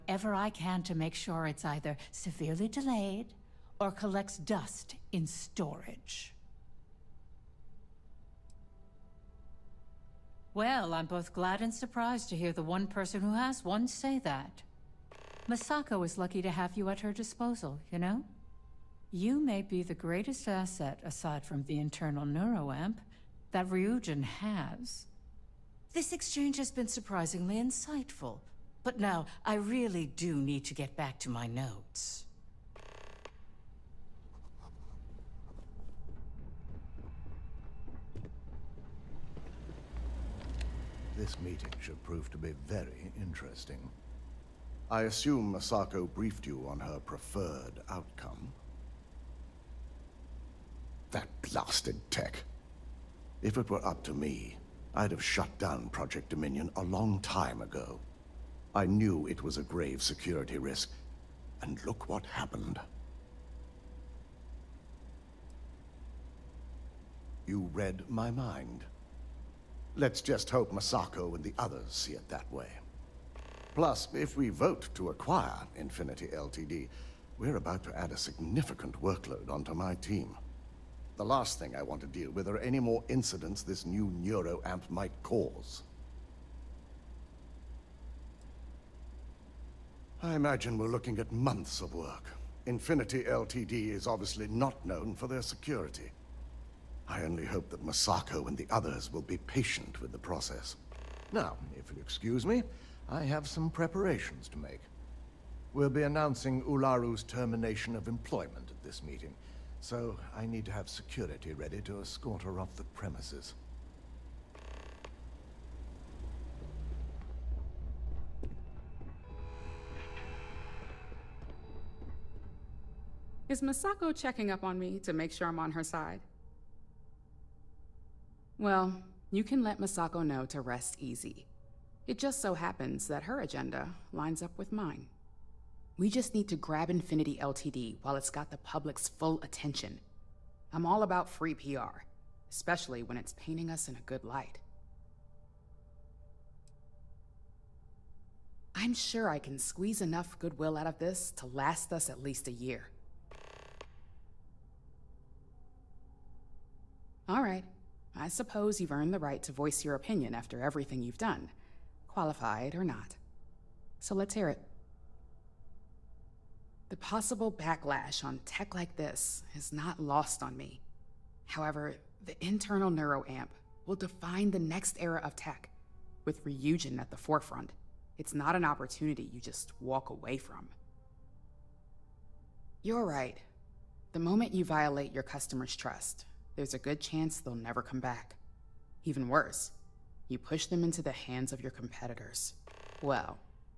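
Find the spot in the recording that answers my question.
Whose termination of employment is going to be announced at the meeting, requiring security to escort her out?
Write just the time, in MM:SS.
01:46.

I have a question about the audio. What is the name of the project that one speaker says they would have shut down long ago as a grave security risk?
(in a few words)
Project Dominion.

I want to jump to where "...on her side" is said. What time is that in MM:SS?
02:05.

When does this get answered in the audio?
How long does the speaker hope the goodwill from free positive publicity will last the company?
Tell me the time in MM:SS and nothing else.
02:32.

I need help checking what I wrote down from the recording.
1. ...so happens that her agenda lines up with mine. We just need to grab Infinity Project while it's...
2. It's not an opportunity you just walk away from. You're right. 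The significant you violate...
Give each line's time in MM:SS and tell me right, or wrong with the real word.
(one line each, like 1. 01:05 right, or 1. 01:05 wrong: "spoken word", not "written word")
1. 02:12 wrong: "LTD", not "Project"
2. 02:58 wrong: "moment", not "significant".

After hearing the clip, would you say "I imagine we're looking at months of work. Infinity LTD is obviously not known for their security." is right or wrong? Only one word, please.
right.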